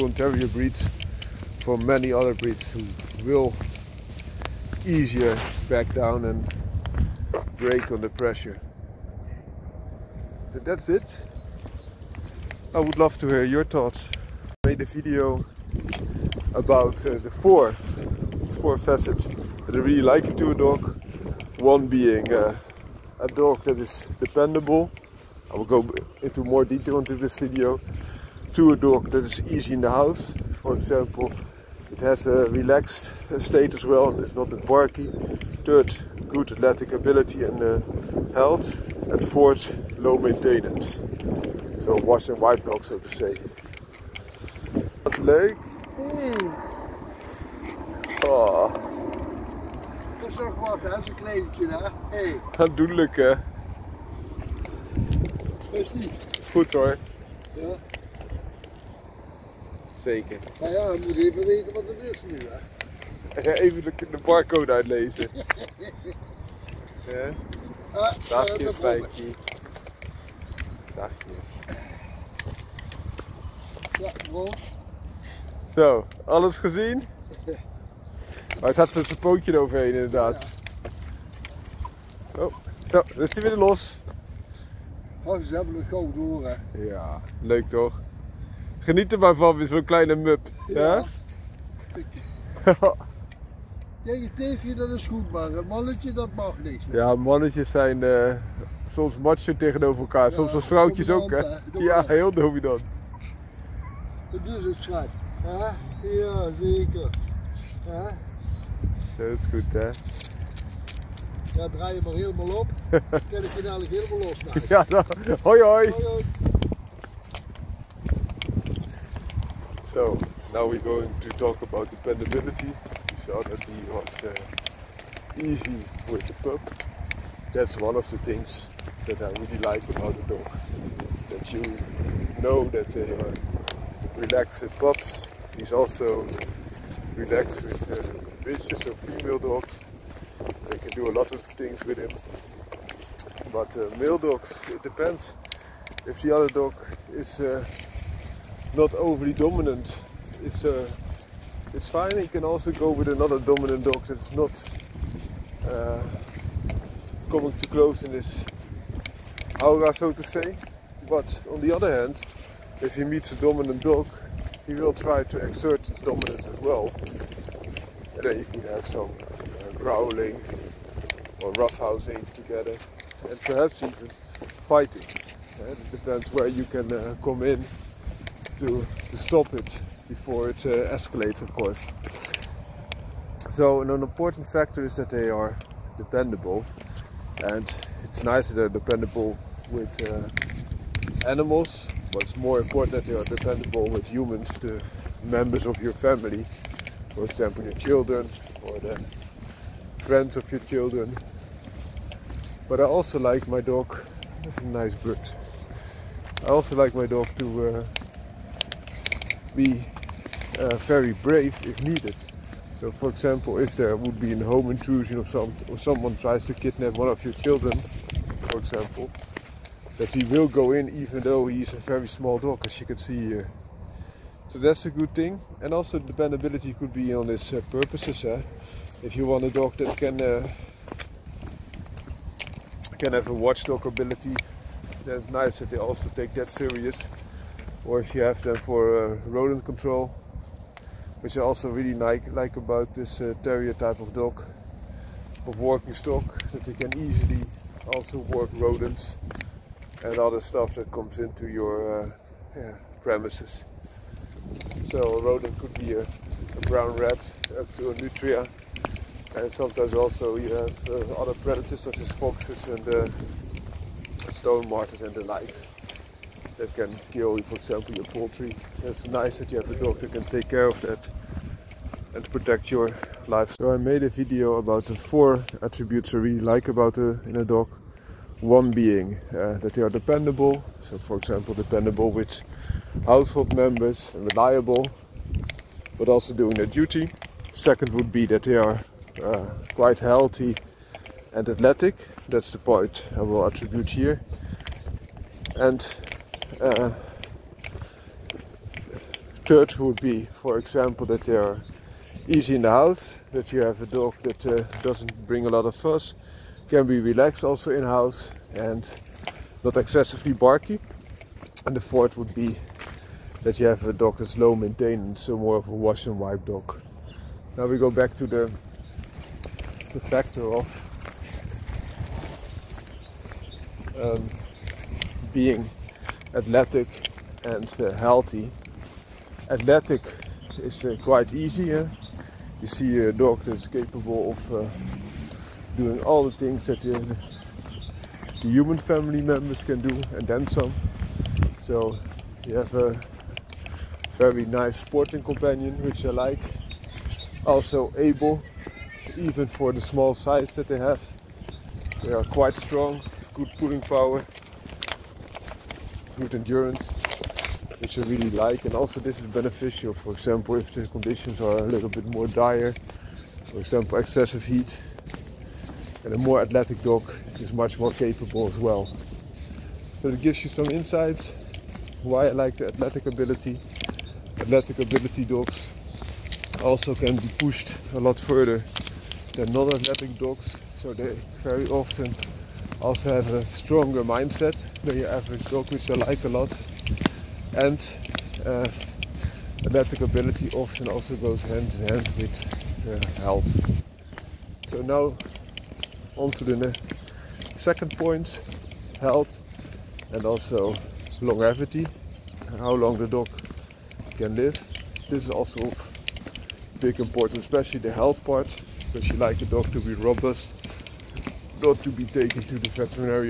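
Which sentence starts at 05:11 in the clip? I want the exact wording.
And the fourth would be that you have a dog that's low maintenance, so more of a wash and wipe dog.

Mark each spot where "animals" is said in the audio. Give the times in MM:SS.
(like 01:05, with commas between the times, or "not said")
03:11.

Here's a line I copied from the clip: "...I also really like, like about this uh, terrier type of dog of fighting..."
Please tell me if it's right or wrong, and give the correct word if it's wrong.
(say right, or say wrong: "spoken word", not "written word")
wrong: "working", not "fighting".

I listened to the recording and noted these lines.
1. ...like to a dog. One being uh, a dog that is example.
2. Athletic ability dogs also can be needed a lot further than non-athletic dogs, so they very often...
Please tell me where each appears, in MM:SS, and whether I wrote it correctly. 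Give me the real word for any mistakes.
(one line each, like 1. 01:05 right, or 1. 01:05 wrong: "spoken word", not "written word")
1. 00:20 wrong: "dependable", not "example"
2. 06:14 wrong: "pushed", not "needed".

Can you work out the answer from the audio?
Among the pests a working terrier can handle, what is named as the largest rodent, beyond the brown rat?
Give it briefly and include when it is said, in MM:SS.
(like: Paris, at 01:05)
nutria, at 04:18.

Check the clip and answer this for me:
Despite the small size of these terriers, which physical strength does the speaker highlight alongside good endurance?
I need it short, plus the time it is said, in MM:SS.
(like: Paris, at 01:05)
pulling power, at 05:53.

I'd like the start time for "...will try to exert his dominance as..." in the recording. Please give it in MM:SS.
02:44.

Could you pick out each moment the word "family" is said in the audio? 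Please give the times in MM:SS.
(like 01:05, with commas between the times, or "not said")
03:15, 05:38.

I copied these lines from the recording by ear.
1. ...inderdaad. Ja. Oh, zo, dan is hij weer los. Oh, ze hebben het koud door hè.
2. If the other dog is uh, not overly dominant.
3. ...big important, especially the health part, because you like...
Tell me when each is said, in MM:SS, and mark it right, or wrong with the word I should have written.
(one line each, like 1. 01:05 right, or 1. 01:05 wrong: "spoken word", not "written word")
1. 01:19 right
2. 02:26 right
3. 06:46 right.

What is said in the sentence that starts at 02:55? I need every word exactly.
Uh, it depends where you can uh, come in to, to stop it before it uh, escalates, of course.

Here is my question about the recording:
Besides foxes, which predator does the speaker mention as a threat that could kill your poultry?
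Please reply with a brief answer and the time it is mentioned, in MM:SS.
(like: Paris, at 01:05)
stone martens, at 04:24.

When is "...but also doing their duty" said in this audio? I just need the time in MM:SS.
04:45.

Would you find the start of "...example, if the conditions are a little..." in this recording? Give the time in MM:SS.
06:00.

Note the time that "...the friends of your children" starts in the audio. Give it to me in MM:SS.
03:18.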